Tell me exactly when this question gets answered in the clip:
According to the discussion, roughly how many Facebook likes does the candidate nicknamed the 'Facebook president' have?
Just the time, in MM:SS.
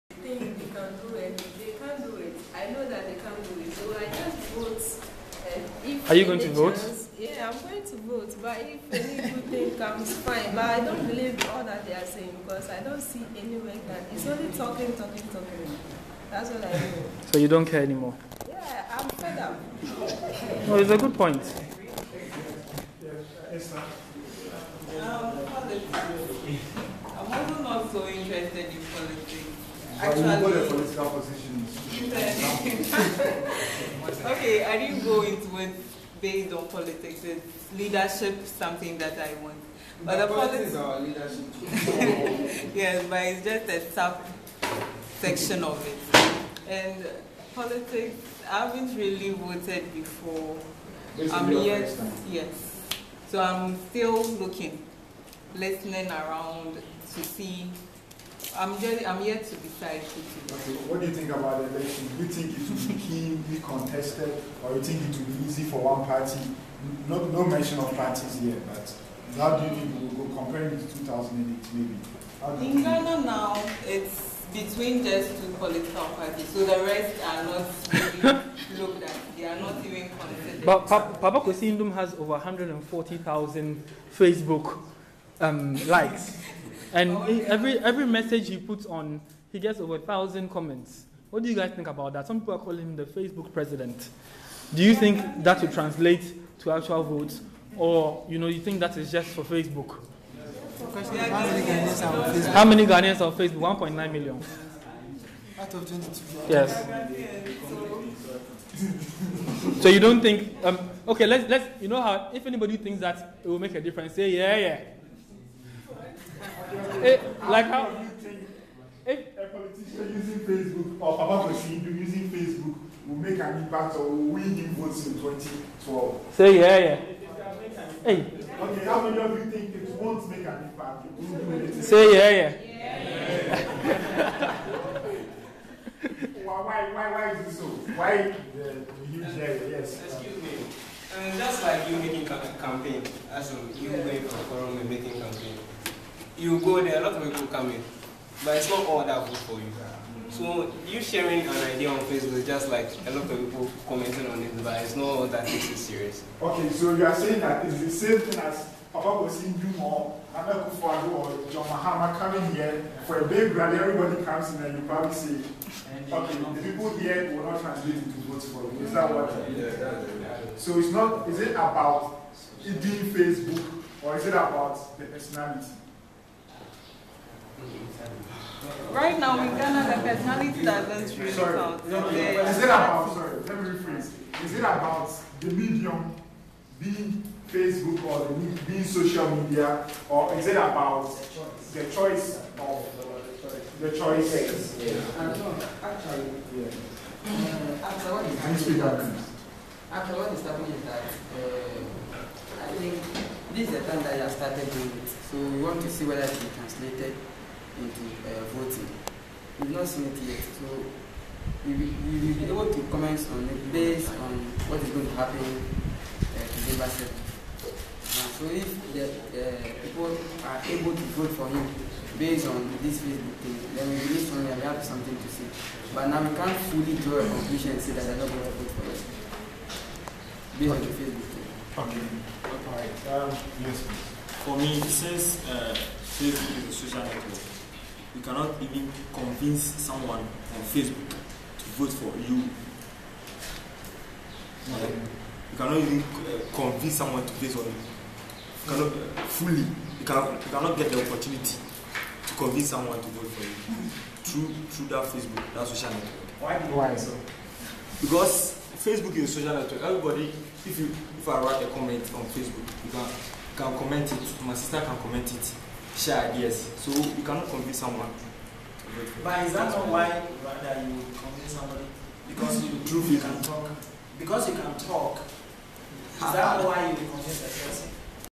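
01:22.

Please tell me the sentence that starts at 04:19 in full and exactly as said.
Everybody, if you if I write a comment on Facebook, you can, you can comment it.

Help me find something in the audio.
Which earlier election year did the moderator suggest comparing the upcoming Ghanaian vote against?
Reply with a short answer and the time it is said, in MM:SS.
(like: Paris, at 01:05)
2008, at 01:10.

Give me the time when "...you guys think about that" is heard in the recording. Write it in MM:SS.
01:31.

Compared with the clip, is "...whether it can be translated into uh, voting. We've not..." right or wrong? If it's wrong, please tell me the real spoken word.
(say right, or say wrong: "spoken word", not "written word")
right.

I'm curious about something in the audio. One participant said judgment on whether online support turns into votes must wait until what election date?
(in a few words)
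December 7th.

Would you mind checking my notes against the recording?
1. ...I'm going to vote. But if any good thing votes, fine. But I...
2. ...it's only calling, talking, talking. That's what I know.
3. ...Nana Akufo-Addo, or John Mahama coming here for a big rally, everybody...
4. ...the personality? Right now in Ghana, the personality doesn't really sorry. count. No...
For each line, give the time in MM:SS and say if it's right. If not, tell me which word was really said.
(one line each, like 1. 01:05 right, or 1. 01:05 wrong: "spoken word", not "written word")
1. 00:07 wrong: "comes", not "votes"
2. 00:14 wrong: "talking", not "calling"
3. 02:40 right
4. 02:54 right.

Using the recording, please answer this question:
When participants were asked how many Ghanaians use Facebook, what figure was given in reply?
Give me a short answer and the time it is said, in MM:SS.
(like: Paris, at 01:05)
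1.9 million, at 01:43.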